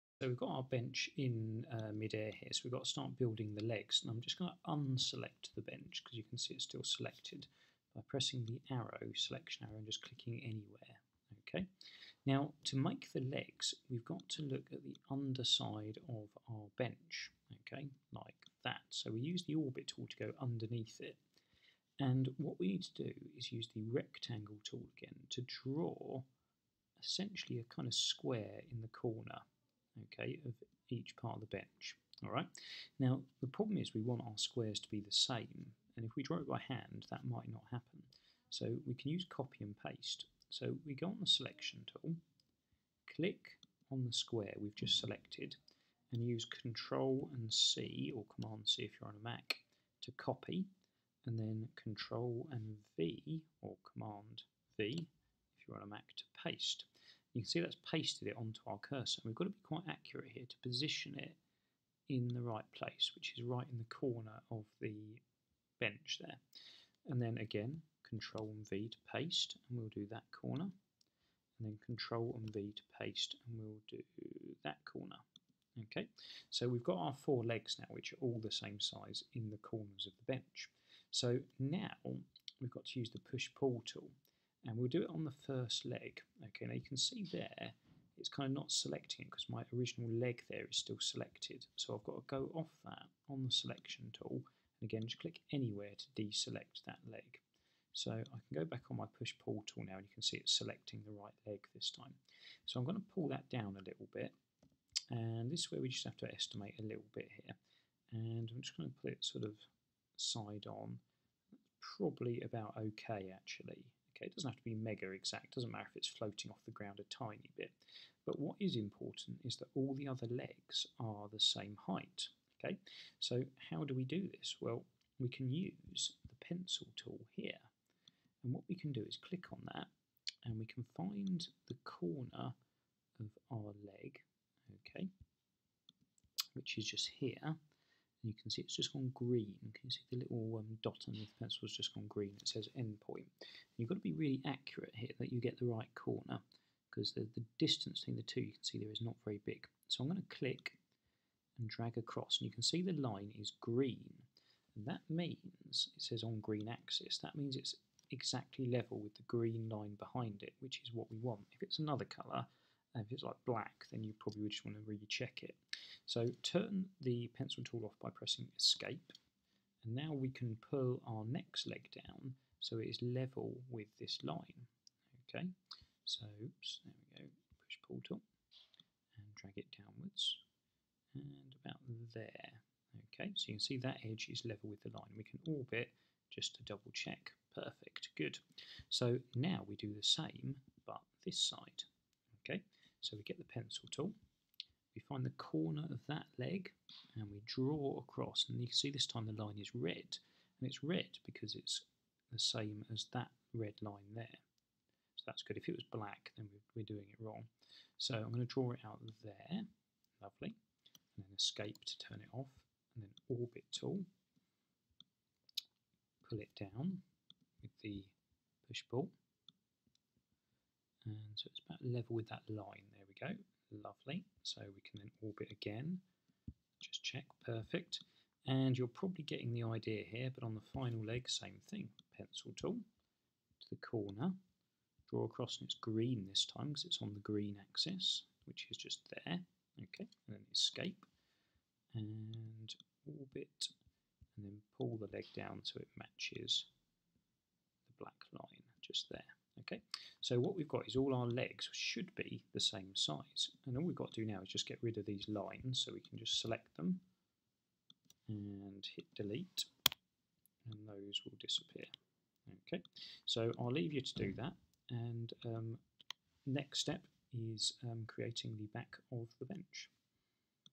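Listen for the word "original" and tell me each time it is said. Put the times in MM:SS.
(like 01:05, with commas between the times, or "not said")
01:29.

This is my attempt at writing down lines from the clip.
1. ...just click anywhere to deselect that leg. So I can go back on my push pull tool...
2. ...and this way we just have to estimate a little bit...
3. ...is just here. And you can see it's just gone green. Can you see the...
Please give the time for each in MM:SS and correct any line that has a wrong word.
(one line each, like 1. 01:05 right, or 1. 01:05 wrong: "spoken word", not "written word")
1. 01:35 right
2. 01:45 right
3. 02:16 right.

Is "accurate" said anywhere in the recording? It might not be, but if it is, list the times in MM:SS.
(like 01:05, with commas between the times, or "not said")
00:59, 02:24.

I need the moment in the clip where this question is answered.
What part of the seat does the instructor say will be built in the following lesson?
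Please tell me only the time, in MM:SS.
04:28.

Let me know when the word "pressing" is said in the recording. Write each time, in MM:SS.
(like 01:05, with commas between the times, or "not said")
00:08, 02:48.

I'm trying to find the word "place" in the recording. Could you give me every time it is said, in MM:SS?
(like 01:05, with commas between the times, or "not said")
01:02.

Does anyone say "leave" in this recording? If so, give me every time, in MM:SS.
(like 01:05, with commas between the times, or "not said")
04:23.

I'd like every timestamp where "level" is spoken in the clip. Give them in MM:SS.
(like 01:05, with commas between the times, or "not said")
02:38, 02:53, 03:04, 03:41.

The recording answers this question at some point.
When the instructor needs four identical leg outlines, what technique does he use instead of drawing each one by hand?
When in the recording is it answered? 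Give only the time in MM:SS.
00:39.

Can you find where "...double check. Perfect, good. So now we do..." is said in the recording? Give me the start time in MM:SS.
03:06.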